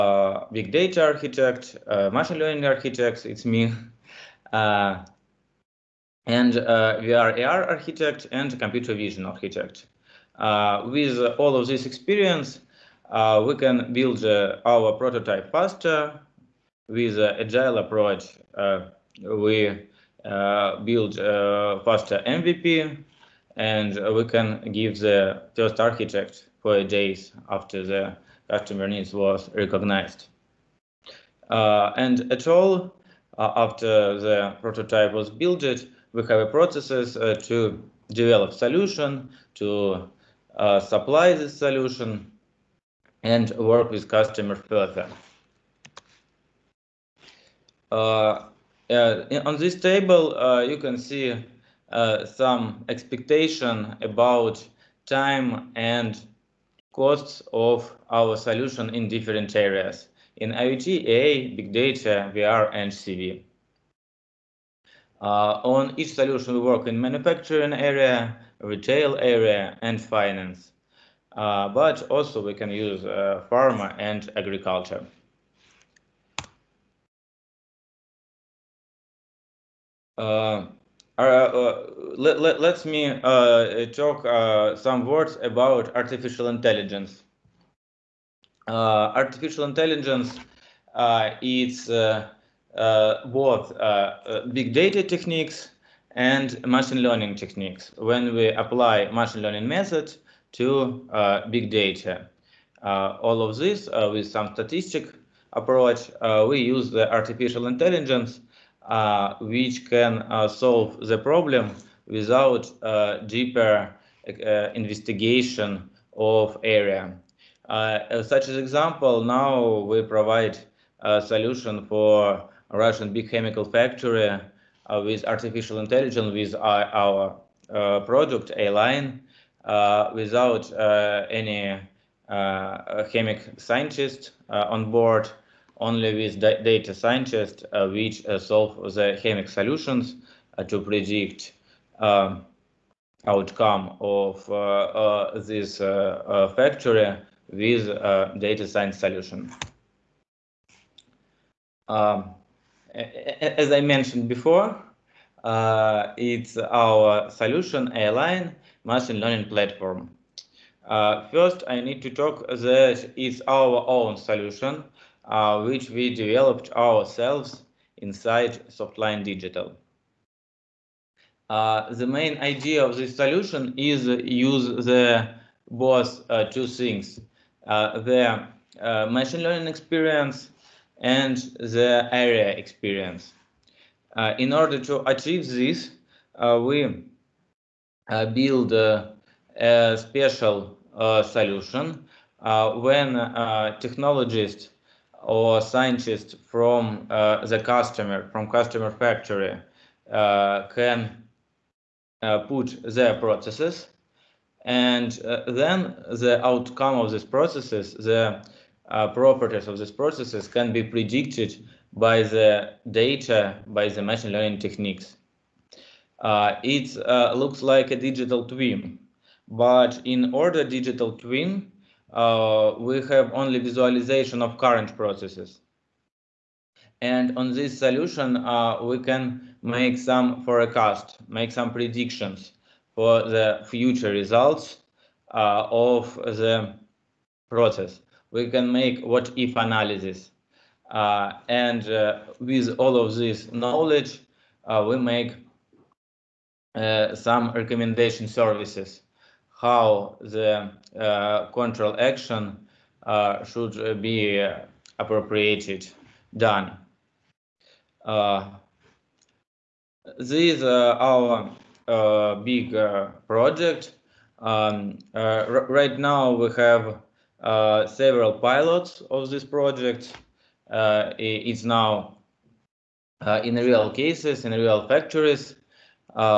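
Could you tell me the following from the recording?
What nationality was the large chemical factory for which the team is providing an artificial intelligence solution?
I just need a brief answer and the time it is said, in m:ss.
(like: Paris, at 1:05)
Russian, at 2:02.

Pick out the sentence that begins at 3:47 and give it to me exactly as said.
And on this solution, uh, we can make some forecast, make some predictions for the future results uh, of the process.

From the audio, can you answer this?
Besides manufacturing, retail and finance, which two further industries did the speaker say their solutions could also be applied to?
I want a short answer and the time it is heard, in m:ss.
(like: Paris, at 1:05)
pharma and agriculture, at 1:13.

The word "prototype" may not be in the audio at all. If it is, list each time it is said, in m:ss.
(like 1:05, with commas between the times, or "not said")
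0:14, 0:34.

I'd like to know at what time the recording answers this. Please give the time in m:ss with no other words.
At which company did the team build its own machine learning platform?
2:48.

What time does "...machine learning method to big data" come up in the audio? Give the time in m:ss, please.
1:39.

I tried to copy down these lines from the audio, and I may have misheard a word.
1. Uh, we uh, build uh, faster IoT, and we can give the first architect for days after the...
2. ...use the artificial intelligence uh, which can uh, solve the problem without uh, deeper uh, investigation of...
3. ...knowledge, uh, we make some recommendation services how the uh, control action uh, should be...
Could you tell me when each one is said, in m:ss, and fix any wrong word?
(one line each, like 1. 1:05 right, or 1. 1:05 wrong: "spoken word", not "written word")
1. 0:18 wrong: "MVP", not "IoT"
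2. 1:46 right
3. 4:03 right.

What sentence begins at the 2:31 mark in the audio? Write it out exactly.
Um, as I mentioned before, uh, it's our solution airline machine learning platform.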